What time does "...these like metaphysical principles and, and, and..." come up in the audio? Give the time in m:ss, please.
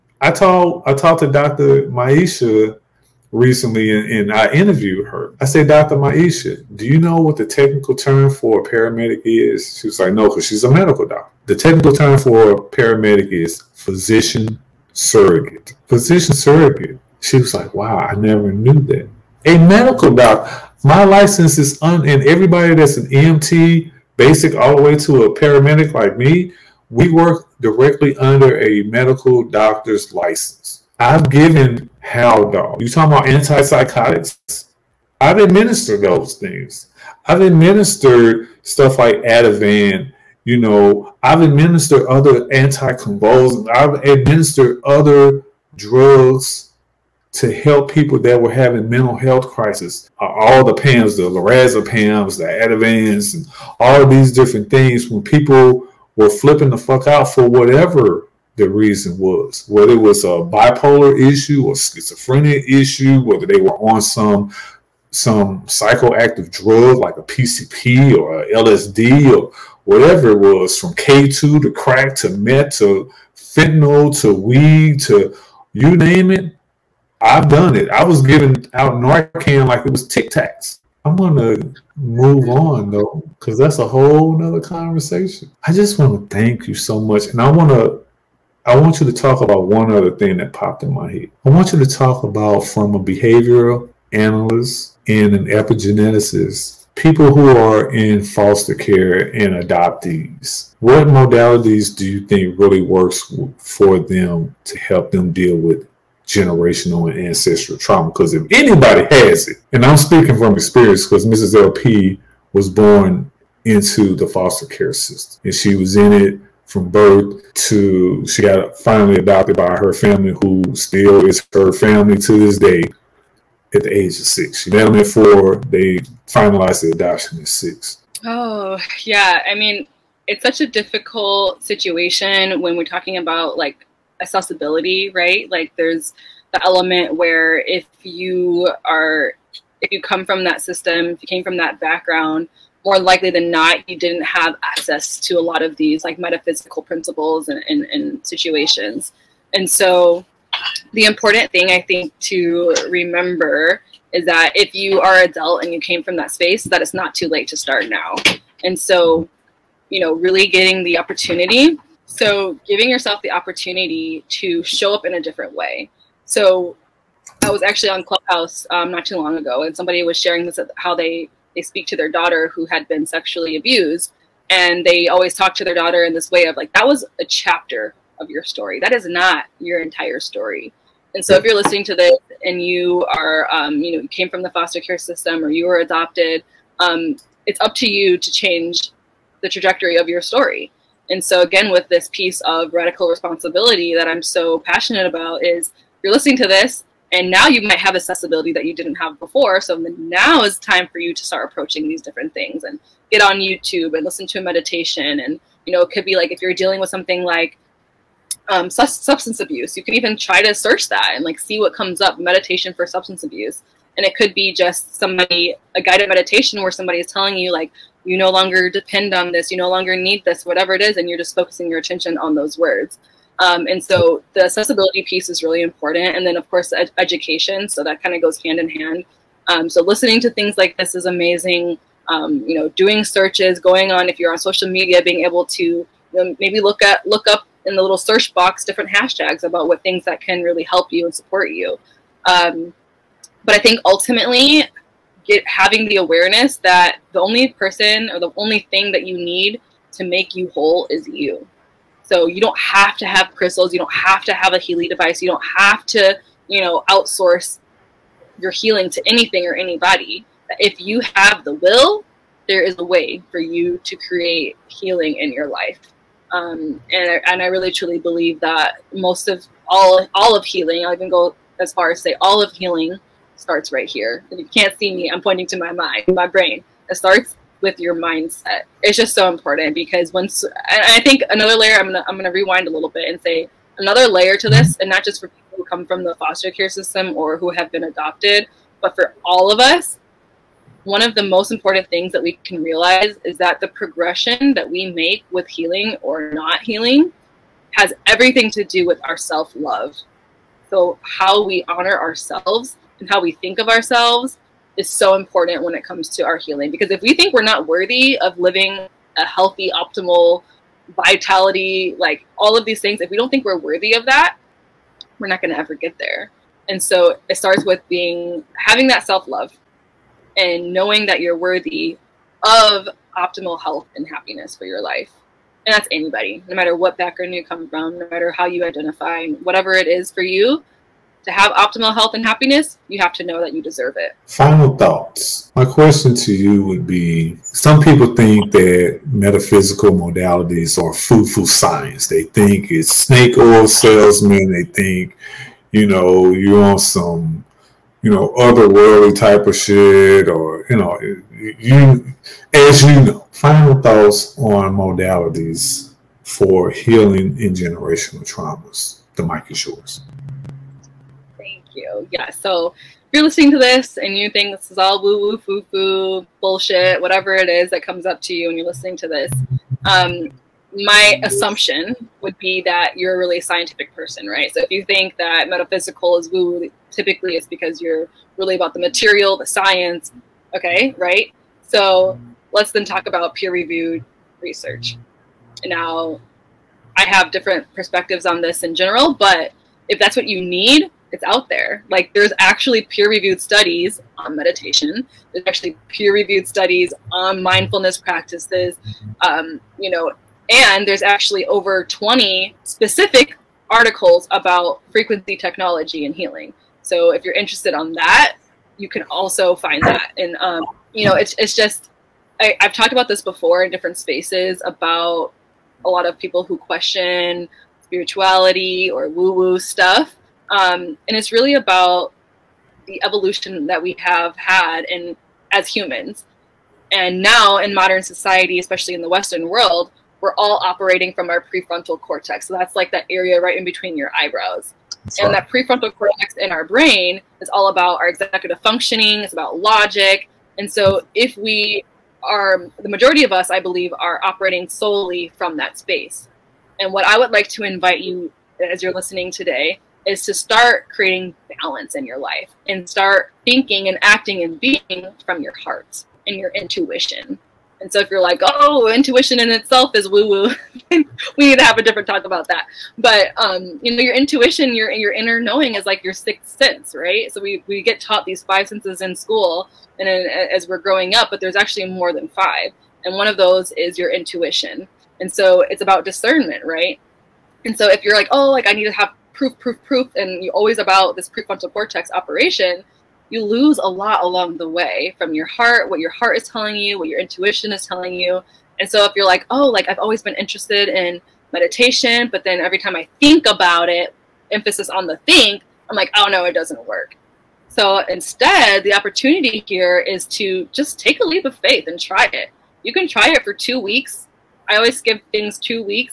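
2:25.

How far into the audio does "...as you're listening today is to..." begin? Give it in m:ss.
7:28.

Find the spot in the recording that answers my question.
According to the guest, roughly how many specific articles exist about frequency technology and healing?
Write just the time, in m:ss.
6:41.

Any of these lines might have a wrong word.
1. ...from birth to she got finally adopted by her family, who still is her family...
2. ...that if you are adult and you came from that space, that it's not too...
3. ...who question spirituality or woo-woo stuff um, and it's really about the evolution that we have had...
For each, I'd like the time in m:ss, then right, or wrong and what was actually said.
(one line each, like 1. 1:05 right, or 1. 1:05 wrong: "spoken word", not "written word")
1. 1:56 right
2. 2:34 right
3. 6:56 right.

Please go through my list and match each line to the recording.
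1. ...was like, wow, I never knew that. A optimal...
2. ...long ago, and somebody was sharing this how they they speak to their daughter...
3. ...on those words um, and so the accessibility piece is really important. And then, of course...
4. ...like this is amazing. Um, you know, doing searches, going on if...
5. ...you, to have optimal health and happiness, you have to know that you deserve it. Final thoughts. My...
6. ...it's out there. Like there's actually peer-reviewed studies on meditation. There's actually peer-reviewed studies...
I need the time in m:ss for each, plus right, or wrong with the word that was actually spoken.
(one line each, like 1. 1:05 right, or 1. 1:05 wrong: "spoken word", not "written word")
1. 0:17 wrong: "medical", not "optimal"
2. 2:49 right
3. 3:42 right
4. 3:50 right
5. 5:30 right
6. 6:31 right.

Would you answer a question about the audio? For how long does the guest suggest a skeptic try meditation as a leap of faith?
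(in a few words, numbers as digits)
2 weeks.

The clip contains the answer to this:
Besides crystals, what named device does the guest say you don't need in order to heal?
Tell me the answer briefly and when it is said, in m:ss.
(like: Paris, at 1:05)
Healy device, at 4:14.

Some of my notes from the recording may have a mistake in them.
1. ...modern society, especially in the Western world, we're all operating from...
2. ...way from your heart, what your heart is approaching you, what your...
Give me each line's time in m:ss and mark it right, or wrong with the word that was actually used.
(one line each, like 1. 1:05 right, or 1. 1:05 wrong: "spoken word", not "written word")
1. 7:07 right
2. 8:04 wrong: "telling", not "approaching".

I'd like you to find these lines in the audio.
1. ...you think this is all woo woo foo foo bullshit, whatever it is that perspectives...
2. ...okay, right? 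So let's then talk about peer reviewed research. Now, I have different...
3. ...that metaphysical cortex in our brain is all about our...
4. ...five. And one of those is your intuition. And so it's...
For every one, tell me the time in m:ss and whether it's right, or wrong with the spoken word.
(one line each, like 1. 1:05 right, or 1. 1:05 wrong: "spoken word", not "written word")
1. 6:04 wrong: "comes", not "perspectives"
2. 6:20 right
3. 7:15 wrong: "prefrontal", not "metaphysical"
4. 7:52 right.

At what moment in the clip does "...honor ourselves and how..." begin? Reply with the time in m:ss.
5:01.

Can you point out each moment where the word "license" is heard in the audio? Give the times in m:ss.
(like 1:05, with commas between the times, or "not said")
0:21, 0:30.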